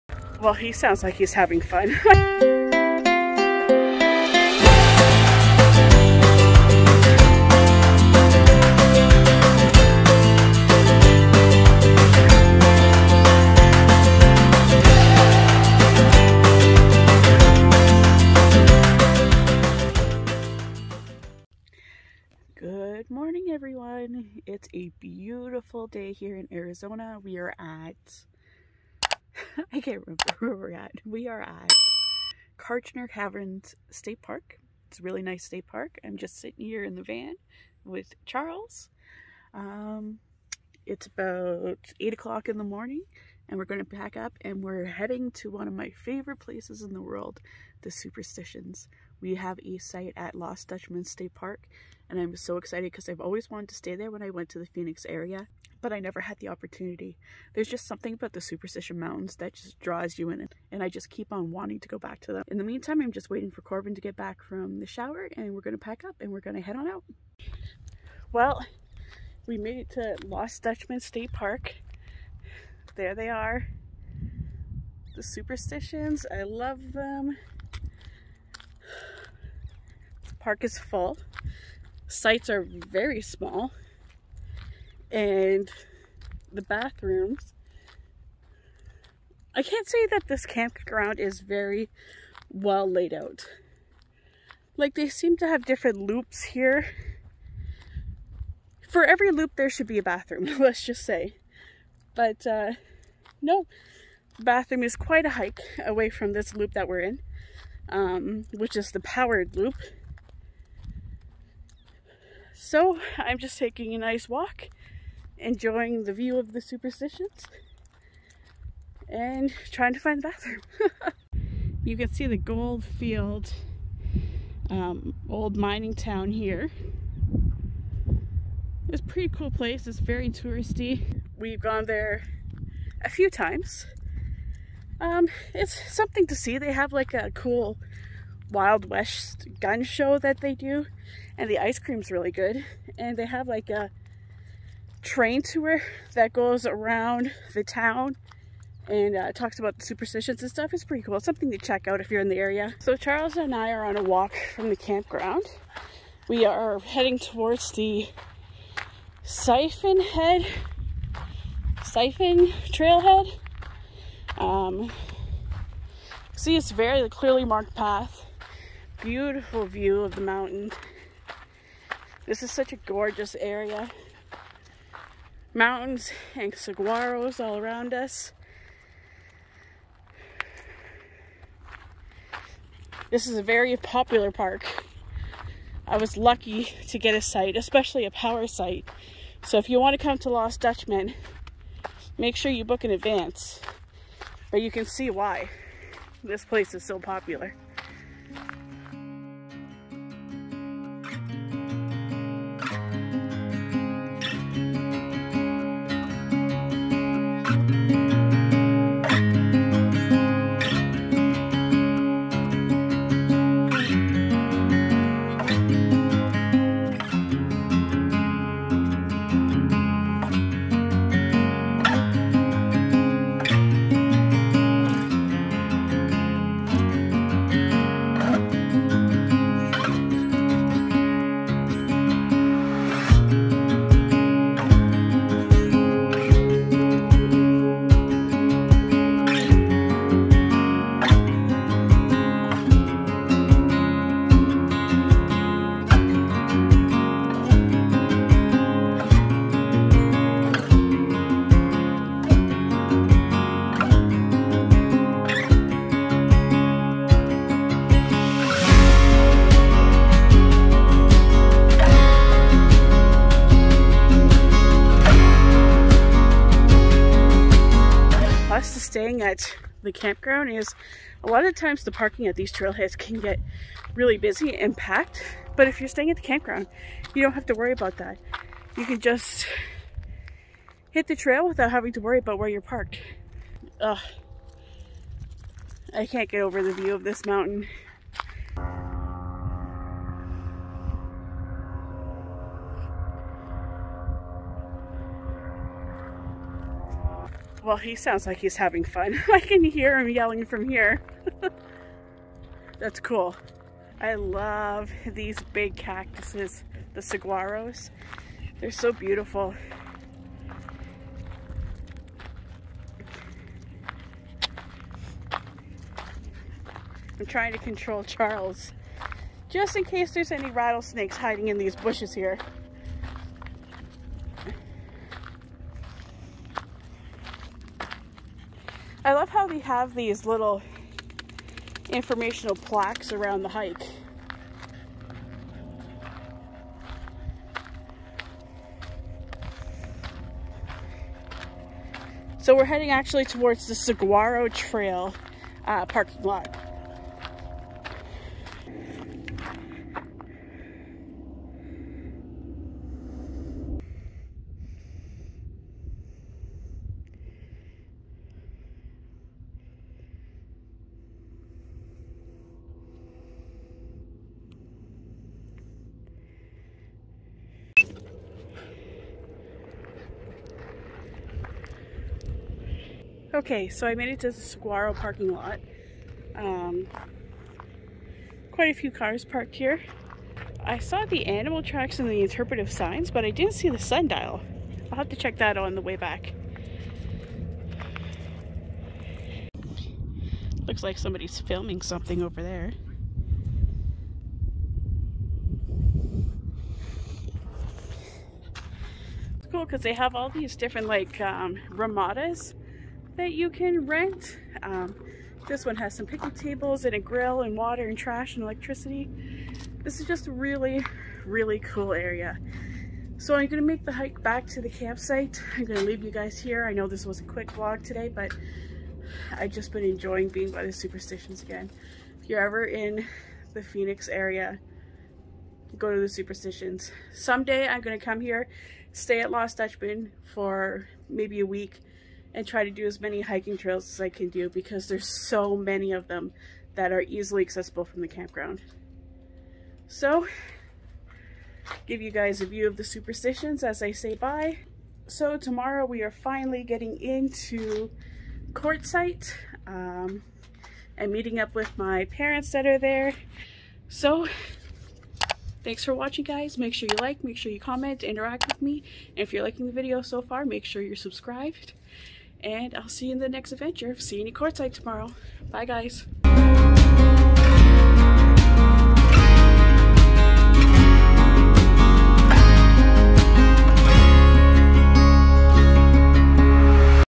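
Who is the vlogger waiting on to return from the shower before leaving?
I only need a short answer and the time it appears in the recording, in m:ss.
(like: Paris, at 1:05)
Corbin, at 1:03.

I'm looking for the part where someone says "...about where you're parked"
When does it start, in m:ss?
4:42.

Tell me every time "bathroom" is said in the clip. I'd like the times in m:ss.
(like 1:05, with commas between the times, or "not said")
1:26, 1:40, 1:44, 2:00.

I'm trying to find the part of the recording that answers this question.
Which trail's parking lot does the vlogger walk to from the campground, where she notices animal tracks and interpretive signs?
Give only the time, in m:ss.
5:43.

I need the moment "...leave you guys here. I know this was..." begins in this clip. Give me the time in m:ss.
6:55.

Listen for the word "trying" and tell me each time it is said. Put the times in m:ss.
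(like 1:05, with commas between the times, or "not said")
1:59, 5:17.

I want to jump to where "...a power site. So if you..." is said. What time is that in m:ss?
3:08.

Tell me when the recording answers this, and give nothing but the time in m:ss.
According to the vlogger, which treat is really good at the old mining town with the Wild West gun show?
2:21.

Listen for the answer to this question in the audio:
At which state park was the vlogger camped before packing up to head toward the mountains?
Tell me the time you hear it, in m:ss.
0:32.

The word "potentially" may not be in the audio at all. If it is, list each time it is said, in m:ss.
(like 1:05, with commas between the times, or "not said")
not said.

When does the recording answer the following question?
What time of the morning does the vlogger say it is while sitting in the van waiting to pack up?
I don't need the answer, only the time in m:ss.
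0:41.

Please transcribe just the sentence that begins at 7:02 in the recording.
If you're ever in the Phoenix area, go to the Superstitions.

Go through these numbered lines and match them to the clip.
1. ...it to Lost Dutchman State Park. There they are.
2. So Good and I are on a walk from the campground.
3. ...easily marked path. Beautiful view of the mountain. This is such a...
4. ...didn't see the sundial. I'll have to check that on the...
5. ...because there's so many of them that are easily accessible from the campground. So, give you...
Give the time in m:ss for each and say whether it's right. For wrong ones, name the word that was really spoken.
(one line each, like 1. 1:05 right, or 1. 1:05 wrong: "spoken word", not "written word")
1. 1:09 right
2. 2:32 wrong: "Charles", not "Good"
3. 2:47 wrong: "clearly", not "easily"
4. 6:23 right
5. 7:14 right.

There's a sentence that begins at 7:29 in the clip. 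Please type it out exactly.
Um, and meeting up with my parents that are there.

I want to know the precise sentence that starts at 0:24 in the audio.
It's a beautiful day here in Arizona.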